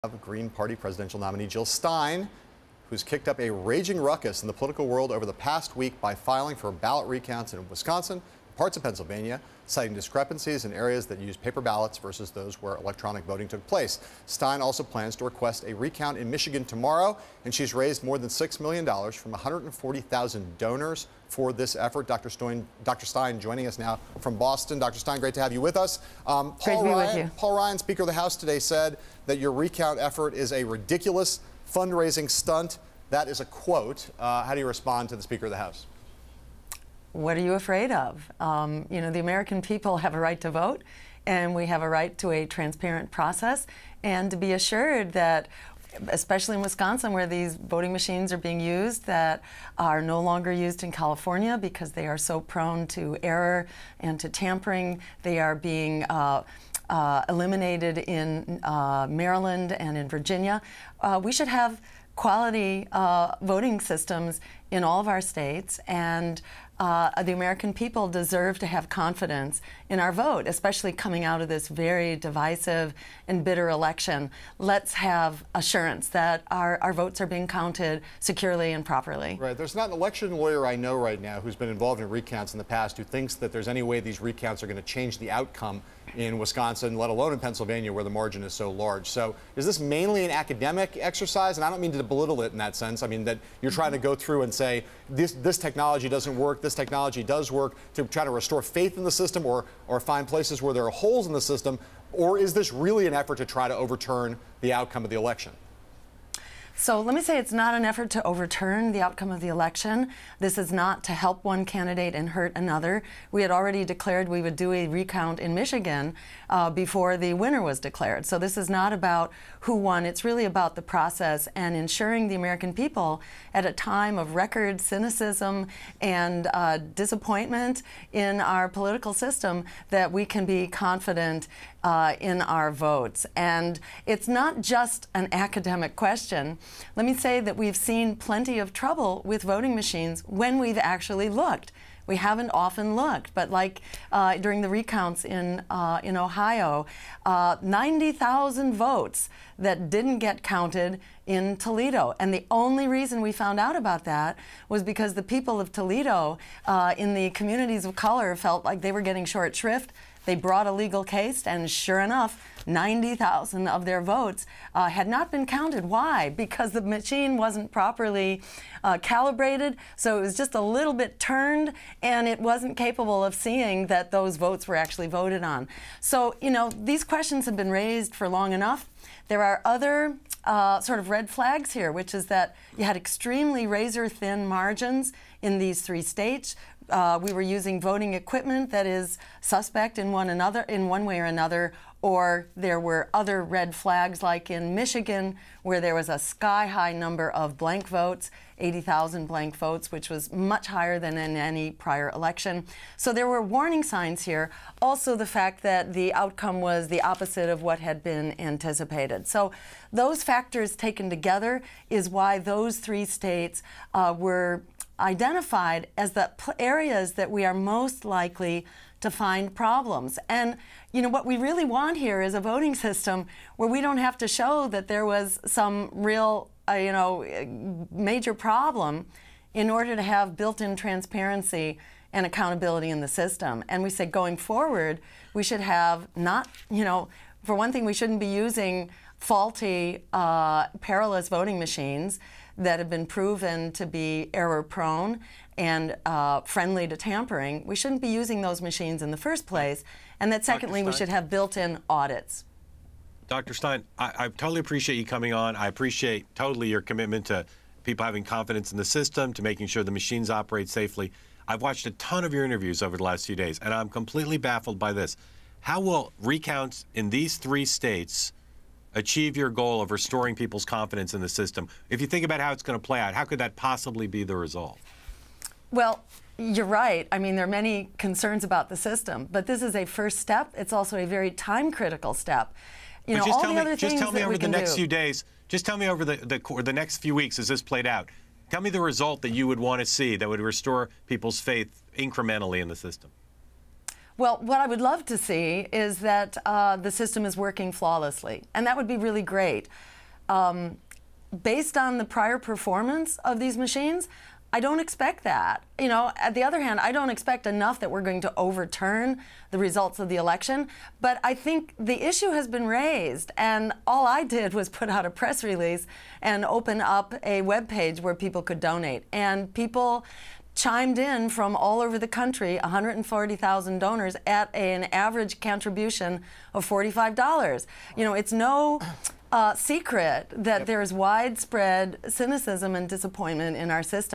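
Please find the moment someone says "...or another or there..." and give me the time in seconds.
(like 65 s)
191 s.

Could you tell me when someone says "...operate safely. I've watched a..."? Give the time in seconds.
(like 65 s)
260 s.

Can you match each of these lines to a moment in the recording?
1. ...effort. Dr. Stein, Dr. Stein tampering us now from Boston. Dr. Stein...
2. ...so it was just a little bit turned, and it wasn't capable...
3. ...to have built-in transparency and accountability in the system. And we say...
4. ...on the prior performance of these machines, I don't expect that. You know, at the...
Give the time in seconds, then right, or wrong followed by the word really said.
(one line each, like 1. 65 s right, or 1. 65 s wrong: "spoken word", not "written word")
1. 21 s wrong: "joining", not "tampering"
2. 169 s right
3. 229 s right
4. 301 s right.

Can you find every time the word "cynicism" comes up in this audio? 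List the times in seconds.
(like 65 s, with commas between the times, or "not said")
124 s, 332 s.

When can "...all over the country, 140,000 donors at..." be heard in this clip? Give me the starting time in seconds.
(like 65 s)
321 s.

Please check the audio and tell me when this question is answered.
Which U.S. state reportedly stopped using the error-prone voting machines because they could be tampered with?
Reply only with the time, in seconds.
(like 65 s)
50 s.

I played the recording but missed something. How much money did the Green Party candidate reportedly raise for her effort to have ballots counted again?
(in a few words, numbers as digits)
more than $6 million.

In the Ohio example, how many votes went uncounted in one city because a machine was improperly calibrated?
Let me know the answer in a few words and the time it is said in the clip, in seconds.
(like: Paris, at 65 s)
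90,000, at 147 s.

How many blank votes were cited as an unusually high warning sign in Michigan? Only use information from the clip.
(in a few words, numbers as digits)
80,000.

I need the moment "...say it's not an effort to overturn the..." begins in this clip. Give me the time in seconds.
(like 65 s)
107 s.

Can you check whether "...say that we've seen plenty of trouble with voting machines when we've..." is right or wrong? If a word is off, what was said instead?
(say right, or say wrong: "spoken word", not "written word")
right.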